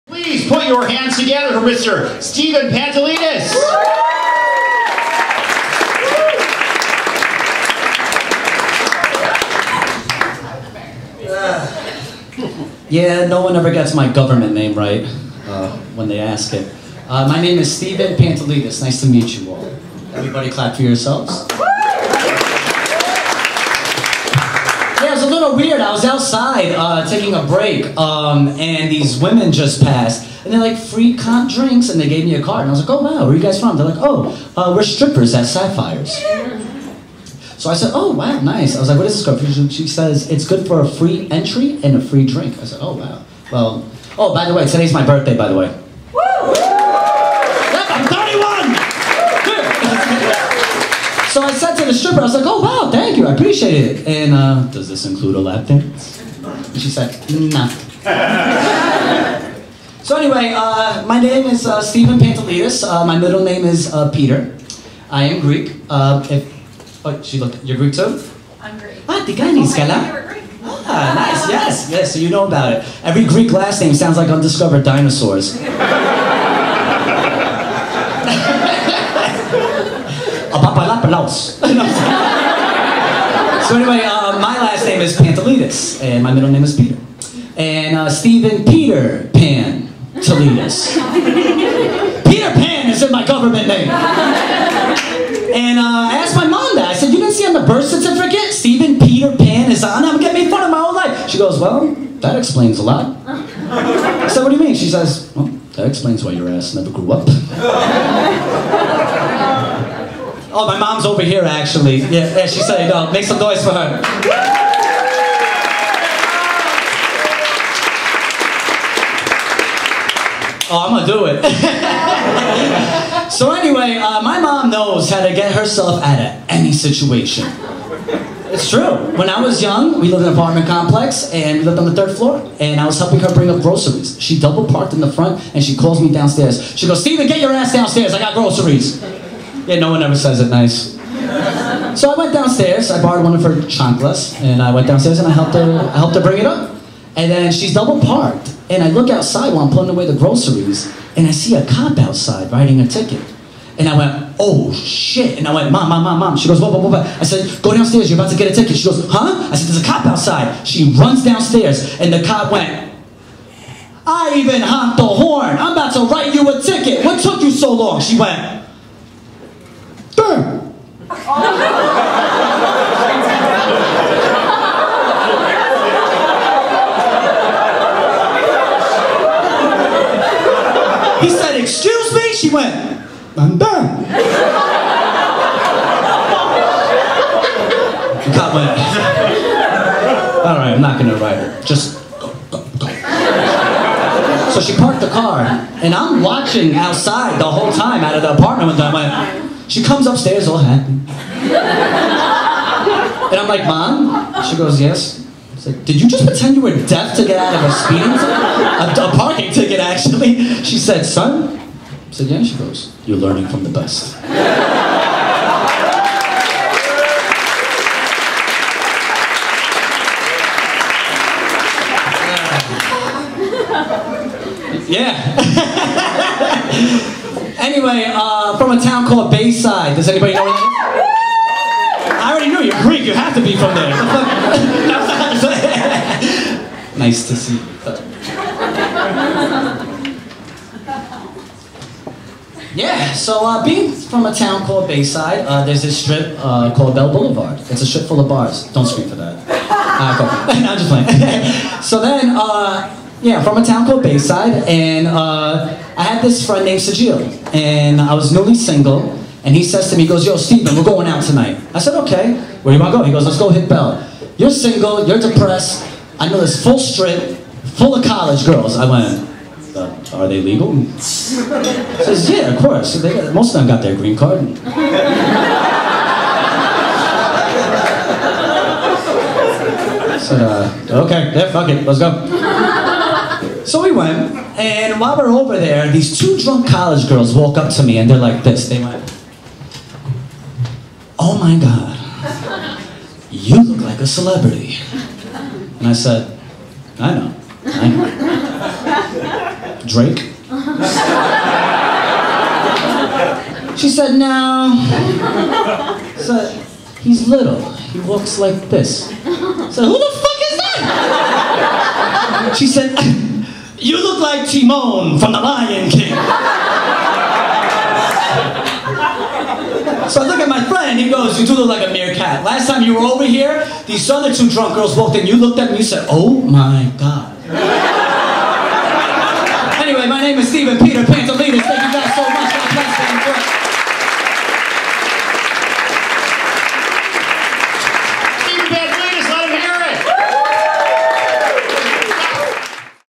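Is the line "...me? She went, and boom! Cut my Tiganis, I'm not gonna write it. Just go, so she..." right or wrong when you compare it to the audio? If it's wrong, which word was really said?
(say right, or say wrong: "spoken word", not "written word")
wrong: "Alright", not "Tiganis".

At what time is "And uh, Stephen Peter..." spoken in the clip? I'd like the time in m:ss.
1:27.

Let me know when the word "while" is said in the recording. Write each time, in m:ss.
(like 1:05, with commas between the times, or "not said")
2:29, 4:44.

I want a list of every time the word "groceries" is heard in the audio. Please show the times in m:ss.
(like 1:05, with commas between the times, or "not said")
2:13, 2:18, 2:30.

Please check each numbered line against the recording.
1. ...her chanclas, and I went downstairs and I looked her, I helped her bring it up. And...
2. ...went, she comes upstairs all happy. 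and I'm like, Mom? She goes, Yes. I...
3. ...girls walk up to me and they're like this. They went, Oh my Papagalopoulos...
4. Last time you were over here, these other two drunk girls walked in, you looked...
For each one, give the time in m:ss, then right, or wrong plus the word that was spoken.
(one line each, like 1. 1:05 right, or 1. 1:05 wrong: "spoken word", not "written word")
1. 2:23 wrong: "helped", not "looked"
2. 3:19 right
3. 4:47 wrong: "God", not "Papagalopoulos"
4. 5:22 right.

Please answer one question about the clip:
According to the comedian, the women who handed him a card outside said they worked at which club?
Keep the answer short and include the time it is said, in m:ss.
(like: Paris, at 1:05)
Sapphires, at 0:35.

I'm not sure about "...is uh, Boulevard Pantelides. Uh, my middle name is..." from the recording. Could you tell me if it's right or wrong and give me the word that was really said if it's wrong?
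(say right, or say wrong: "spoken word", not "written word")
wrong: "Stephen", not "Boulevard".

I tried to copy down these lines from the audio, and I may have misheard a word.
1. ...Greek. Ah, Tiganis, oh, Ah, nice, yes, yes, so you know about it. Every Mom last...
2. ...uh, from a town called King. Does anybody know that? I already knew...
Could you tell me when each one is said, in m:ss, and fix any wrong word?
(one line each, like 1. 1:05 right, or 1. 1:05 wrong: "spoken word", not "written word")
1. 1:08 wrong: "Greek", not "Mom"
2. 3:48 wrong: "Bayside", not "King".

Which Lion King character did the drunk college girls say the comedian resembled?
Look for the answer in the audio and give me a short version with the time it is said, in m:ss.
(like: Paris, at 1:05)
Timon, at 5:14.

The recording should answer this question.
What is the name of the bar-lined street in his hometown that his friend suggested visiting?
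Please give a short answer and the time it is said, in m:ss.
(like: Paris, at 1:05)
Bell Boulevard, at 4:06.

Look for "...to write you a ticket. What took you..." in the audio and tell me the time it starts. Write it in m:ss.
2:45.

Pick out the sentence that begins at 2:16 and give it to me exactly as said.
She goes, Stephen, get your ass downstairs.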